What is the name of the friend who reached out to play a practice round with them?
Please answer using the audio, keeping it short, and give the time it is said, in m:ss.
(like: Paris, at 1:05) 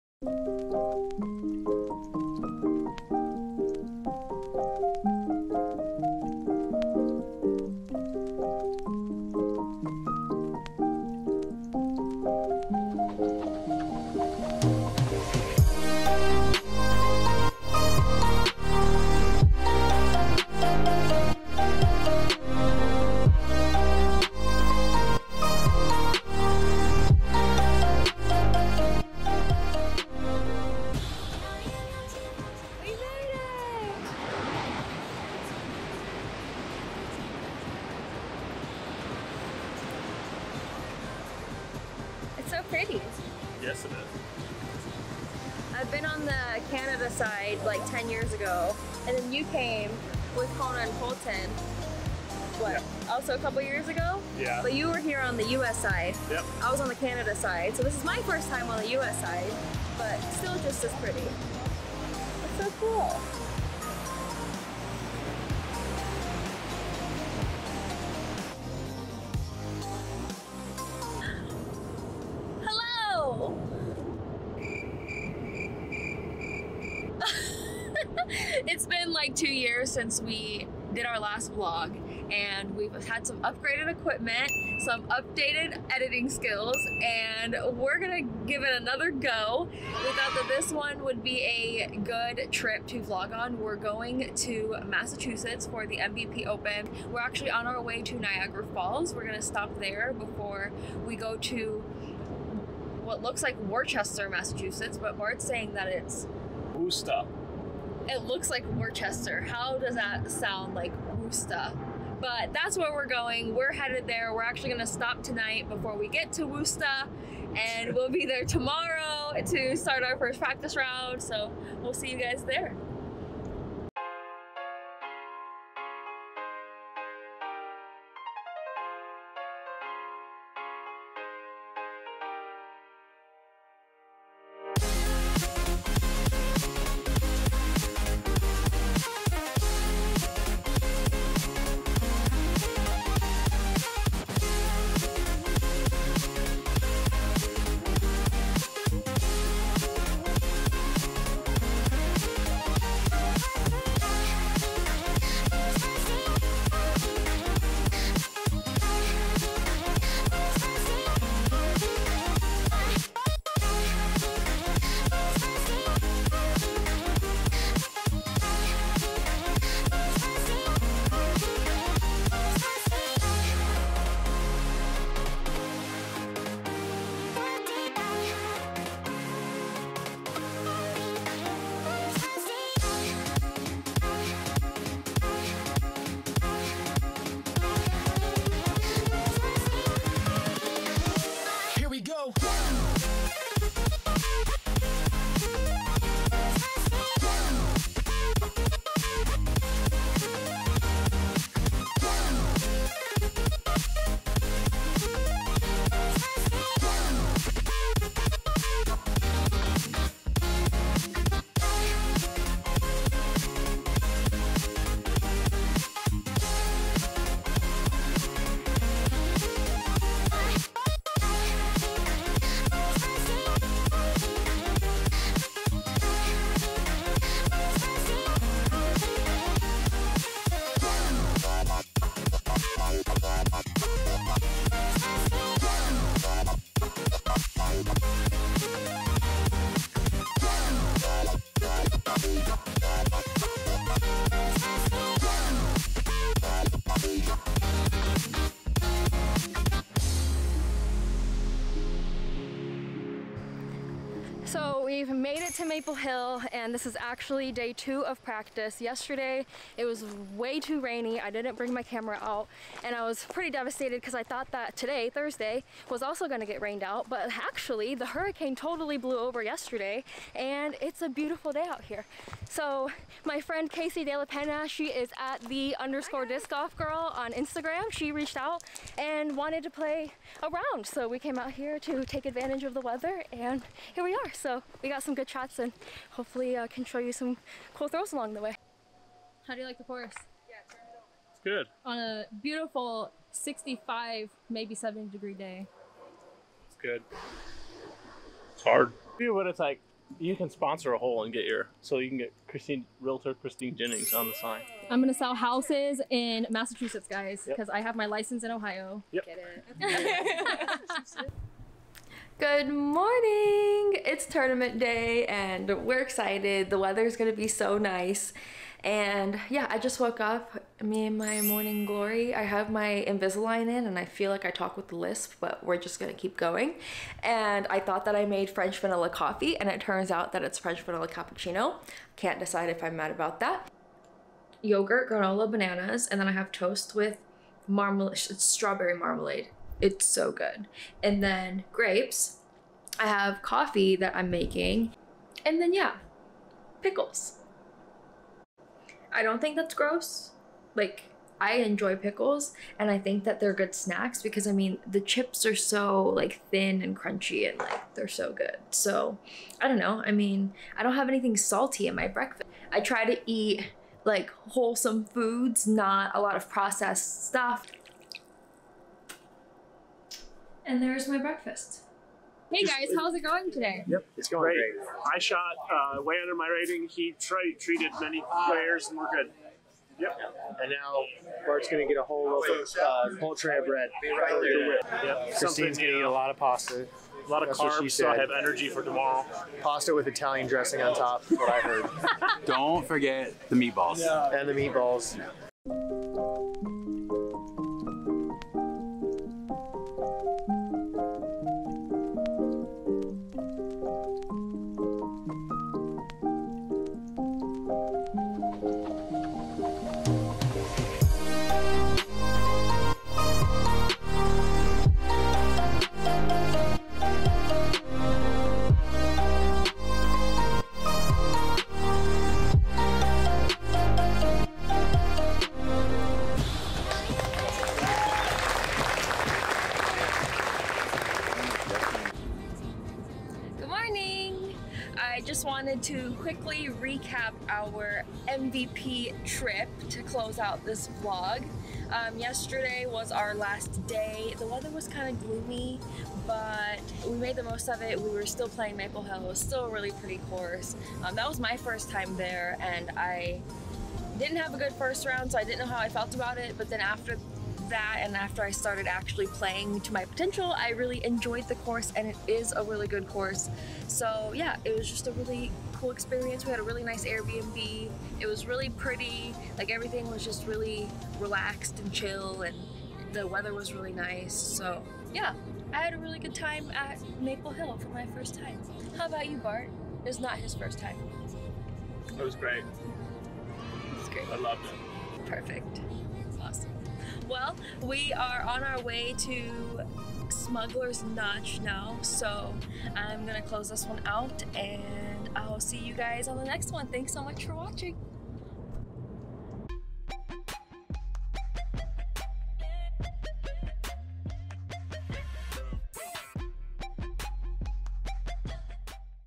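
Casey De La Pena, at 4:33.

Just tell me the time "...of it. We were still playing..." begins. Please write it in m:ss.
7:27.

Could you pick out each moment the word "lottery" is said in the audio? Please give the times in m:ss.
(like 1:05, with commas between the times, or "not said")
not said.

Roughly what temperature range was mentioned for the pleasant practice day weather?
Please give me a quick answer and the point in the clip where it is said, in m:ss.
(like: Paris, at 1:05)
65 to 70 degrees, at 4:53.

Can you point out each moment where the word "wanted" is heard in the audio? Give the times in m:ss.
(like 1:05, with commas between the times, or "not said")
4:39, 7:15.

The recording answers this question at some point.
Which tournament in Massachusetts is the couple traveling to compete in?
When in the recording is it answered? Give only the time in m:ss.
1:35.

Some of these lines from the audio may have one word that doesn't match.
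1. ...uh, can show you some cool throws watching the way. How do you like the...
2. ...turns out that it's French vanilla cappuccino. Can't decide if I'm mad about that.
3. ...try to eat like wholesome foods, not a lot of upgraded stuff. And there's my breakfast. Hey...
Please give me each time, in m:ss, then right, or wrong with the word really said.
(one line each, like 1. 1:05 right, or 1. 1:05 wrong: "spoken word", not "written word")
1. 4:46 wrong: "along", not "watching"
2. 5:29 right
3. 6:02 wrong: "processed", not "upgraded".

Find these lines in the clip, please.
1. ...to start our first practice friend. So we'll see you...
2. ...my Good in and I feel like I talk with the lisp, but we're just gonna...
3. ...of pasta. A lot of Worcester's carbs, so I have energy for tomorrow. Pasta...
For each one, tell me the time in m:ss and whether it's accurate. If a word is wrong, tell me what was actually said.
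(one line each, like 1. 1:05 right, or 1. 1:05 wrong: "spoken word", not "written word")
1. 1:59 wrong: "round", not "friend"
2. 5:22 wrong: "Invisalign", not "Good"
3. 6:26 wrong: "That", not "Worcester".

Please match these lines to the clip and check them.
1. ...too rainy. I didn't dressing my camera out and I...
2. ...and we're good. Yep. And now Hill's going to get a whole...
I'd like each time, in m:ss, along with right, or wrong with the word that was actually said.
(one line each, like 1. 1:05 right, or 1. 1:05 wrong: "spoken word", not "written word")
1. 4:20 wrong: "bring", not "dressing"
2. 6:18 wrong: "Bart", not "Hill".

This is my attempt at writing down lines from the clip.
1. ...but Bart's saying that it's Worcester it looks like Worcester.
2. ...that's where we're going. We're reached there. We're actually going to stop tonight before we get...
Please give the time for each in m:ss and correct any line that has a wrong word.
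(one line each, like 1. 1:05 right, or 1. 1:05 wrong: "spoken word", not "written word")
1. 1:44 right
2. 1:52 wrong: "headed", not "reached".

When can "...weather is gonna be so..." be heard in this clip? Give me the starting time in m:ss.
5:16.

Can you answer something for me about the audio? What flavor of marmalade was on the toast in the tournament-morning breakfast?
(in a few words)
Strawberry.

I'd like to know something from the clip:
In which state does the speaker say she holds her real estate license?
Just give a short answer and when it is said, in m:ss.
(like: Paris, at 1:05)
Ohio, at 5:08.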